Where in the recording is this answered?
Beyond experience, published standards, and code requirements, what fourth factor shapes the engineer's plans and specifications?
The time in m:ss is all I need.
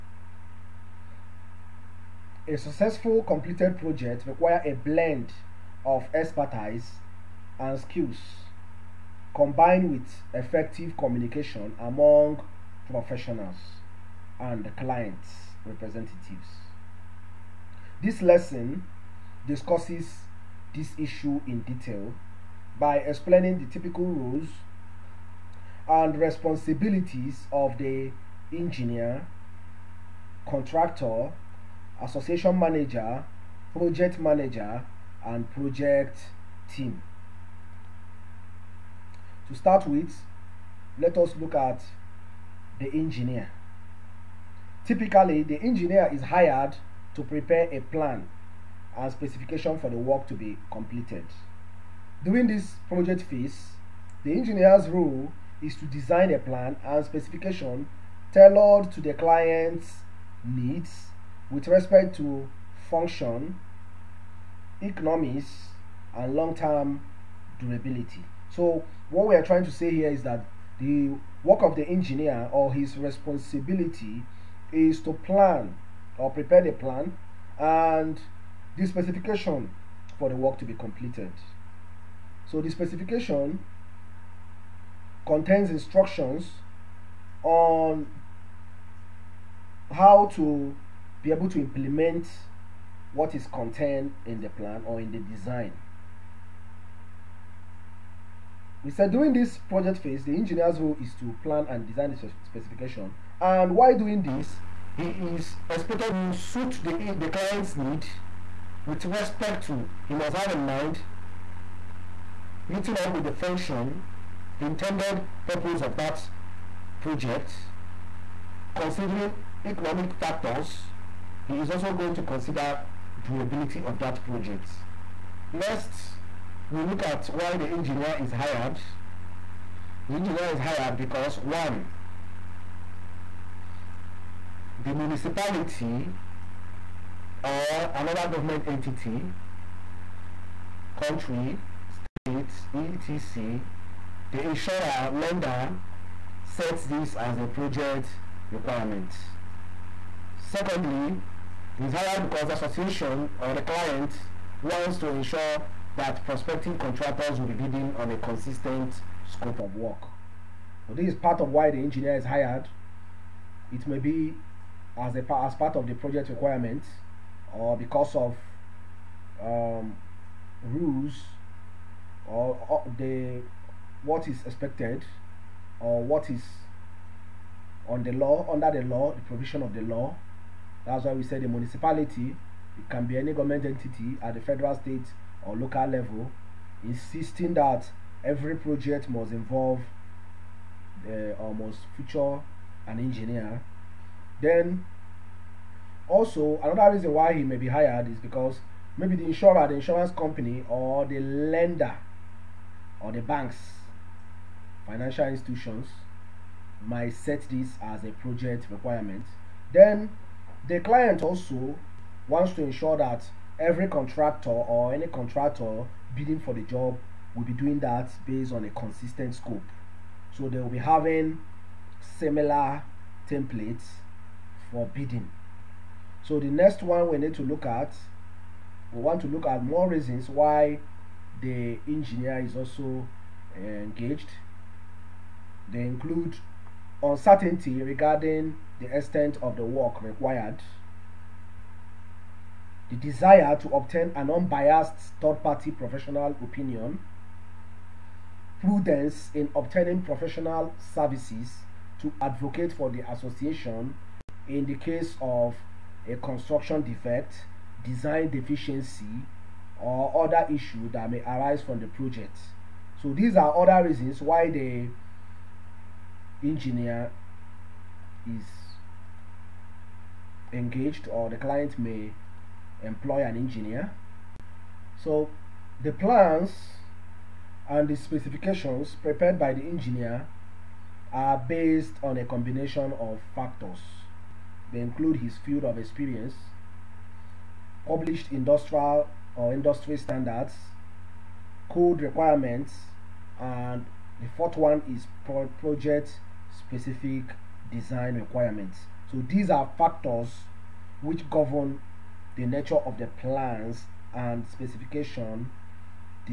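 4:55.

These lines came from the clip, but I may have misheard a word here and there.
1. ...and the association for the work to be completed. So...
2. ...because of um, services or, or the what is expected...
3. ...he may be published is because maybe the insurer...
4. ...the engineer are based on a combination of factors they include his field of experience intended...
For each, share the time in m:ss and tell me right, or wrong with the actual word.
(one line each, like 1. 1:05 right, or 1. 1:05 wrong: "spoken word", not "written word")
1. 1:17 wrong: "specification", not "association"
2. 2:47 wrong: "rules", not "services"
3. 3:17 wrong: "hired", not "published"
4. 4:39 wrong: "published", not "intended".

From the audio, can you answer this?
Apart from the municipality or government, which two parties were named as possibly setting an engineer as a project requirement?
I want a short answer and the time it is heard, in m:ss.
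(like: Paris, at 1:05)
insurer, lender, at 2:24.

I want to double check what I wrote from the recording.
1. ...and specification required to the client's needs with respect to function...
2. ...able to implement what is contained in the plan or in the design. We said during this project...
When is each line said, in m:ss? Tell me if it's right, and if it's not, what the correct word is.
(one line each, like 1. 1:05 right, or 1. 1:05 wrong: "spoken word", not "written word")
1. 0:56 wrong: "tailored", not "required"
2. 1:31 right.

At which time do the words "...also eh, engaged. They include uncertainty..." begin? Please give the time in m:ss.
3:52.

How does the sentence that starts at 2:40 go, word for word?
So this is part of why the engineer is hired.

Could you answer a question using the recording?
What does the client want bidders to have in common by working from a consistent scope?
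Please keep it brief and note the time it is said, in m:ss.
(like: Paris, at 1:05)
templates for bidding, at 3:43.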